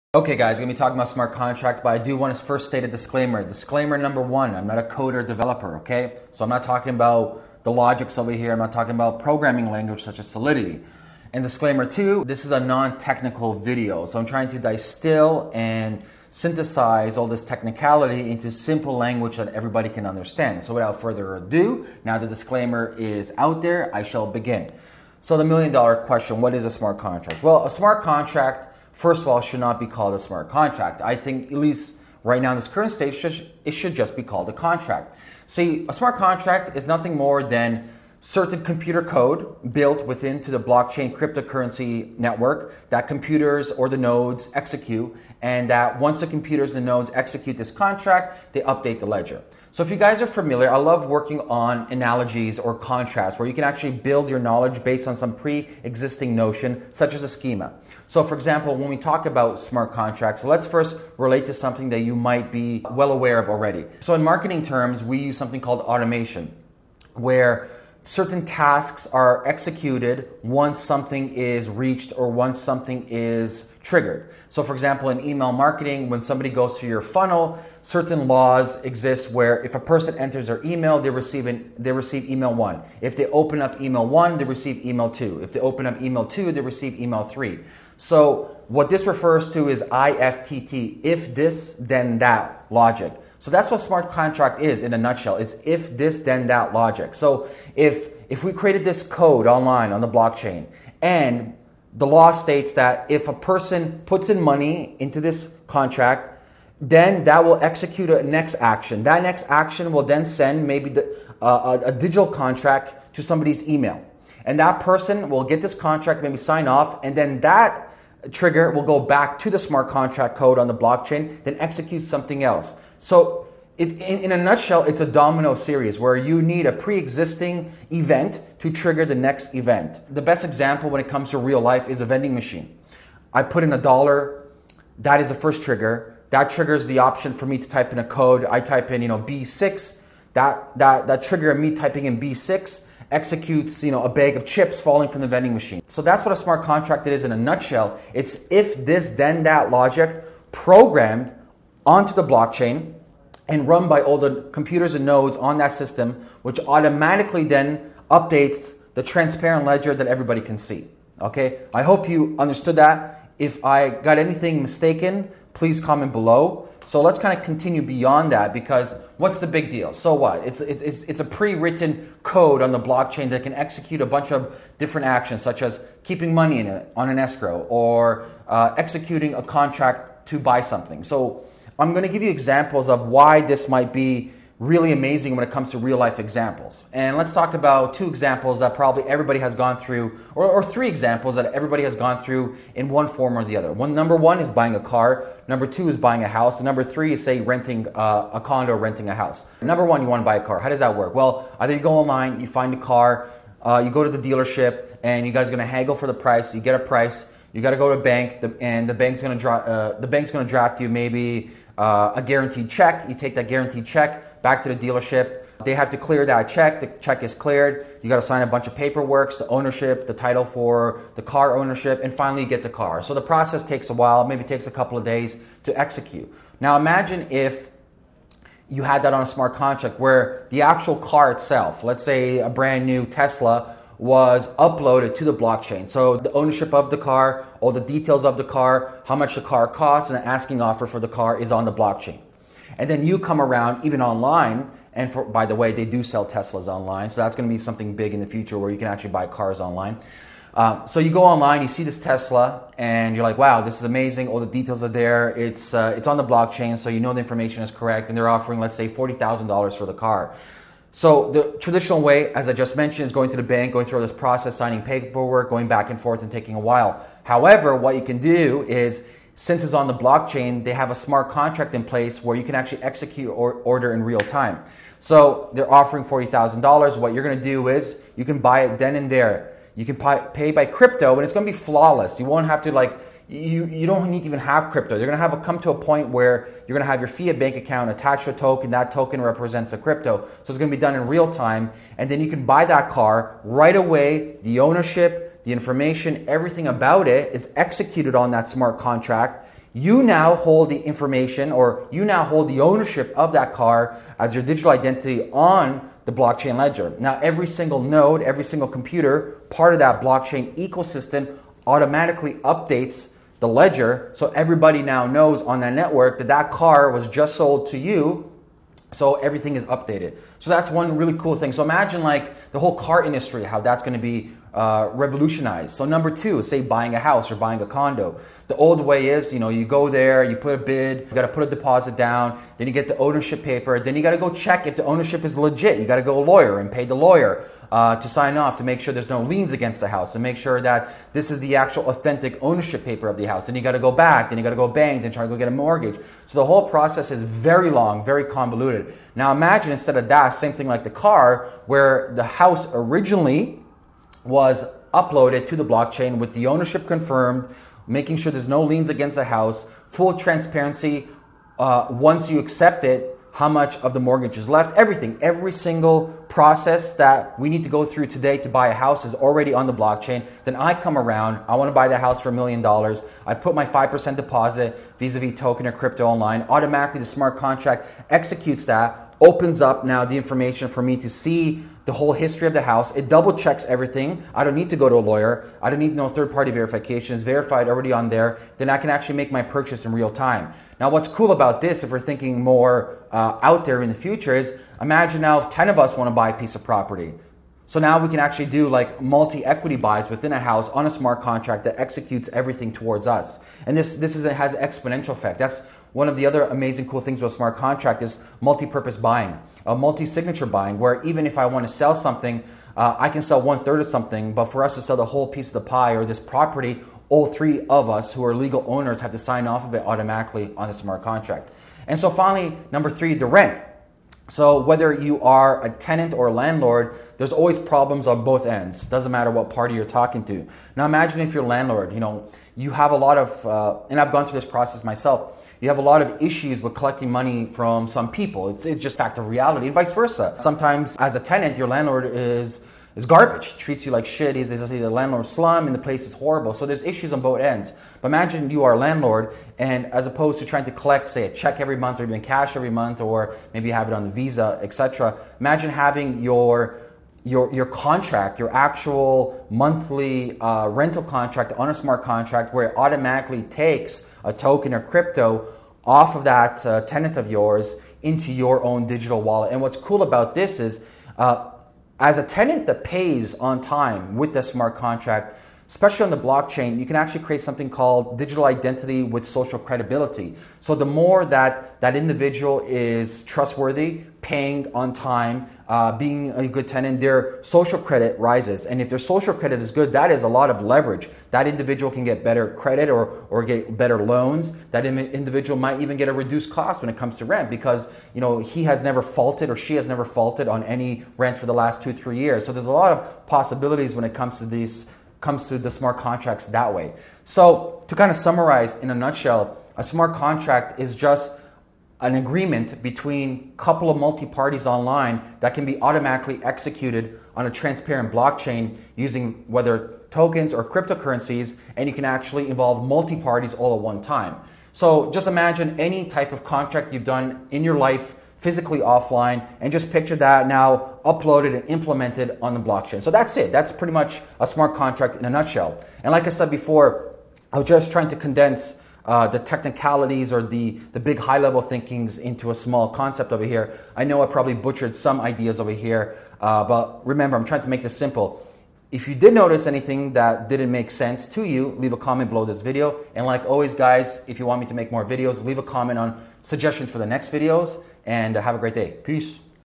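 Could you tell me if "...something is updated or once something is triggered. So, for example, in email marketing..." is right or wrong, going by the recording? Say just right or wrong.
wrong.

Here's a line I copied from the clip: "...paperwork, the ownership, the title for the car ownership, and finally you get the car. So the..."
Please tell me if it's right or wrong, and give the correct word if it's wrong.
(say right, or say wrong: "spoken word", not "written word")
right.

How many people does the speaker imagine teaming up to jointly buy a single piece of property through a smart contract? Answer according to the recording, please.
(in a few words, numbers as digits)
10.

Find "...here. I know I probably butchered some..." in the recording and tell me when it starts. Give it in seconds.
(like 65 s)
543 s.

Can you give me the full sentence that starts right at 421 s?
And so finally, number three, the rent.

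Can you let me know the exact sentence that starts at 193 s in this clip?
One number one is buying a car.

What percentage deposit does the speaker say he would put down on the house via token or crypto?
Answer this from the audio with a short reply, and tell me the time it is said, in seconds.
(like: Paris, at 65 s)
5%, at 373 s.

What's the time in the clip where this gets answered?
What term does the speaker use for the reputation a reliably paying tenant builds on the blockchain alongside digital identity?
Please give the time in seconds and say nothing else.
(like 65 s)
479 s.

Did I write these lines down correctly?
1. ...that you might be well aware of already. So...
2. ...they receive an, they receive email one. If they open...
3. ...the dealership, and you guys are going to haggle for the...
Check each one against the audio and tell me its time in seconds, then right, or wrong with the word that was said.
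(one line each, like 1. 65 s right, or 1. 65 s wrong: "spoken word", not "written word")
1. 61 s right
2. 80 s right
3. 204 s right.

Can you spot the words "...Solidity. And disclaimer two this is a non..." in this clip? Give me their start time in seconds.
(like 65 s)
10 s.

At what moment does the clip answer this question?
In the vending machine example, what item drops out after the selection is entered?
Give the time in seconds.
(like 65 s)
144 s.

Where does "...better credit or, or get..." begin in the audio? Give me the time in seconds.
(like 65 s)
492 s.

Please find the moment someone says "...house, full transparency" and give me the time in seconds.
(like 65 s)
359 s.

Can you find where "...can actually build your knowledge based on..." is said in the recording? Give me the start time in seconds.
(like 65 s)
53 s.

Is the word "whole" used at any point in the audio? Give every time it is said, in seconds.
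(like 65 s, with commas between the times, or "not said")
322 s, 346 s, 381 s, 415 s.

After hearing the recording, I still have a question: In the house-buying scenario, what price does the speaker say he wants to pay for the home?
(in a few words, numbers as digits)
a million dollars.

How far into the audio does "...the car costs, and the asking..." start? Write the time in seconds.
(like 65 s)
239 s.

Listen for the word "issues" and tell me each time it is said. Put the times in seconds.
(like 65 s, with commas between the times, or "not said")
436 s, 446 s.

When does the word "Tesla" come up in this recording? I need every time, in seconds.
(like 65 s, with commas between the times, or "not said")
233 s, 246 s, 251 s.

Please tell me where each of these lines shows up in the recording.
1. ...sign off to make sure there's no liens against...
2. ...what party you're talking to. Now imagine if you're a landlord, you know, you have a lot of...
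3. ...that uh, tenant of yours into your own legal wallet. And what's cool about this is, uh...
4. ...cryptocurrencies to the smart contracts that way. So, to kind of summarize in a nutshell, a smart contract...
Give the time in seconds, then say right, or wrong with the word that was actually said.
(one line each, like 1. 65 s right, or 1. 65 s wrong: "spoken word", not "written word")
1. 338 s right
2. 429 s right
3. 466 s wrong: "digital", not "legal"
4. 505 s wrong: "comes", not "cryptocurrencies".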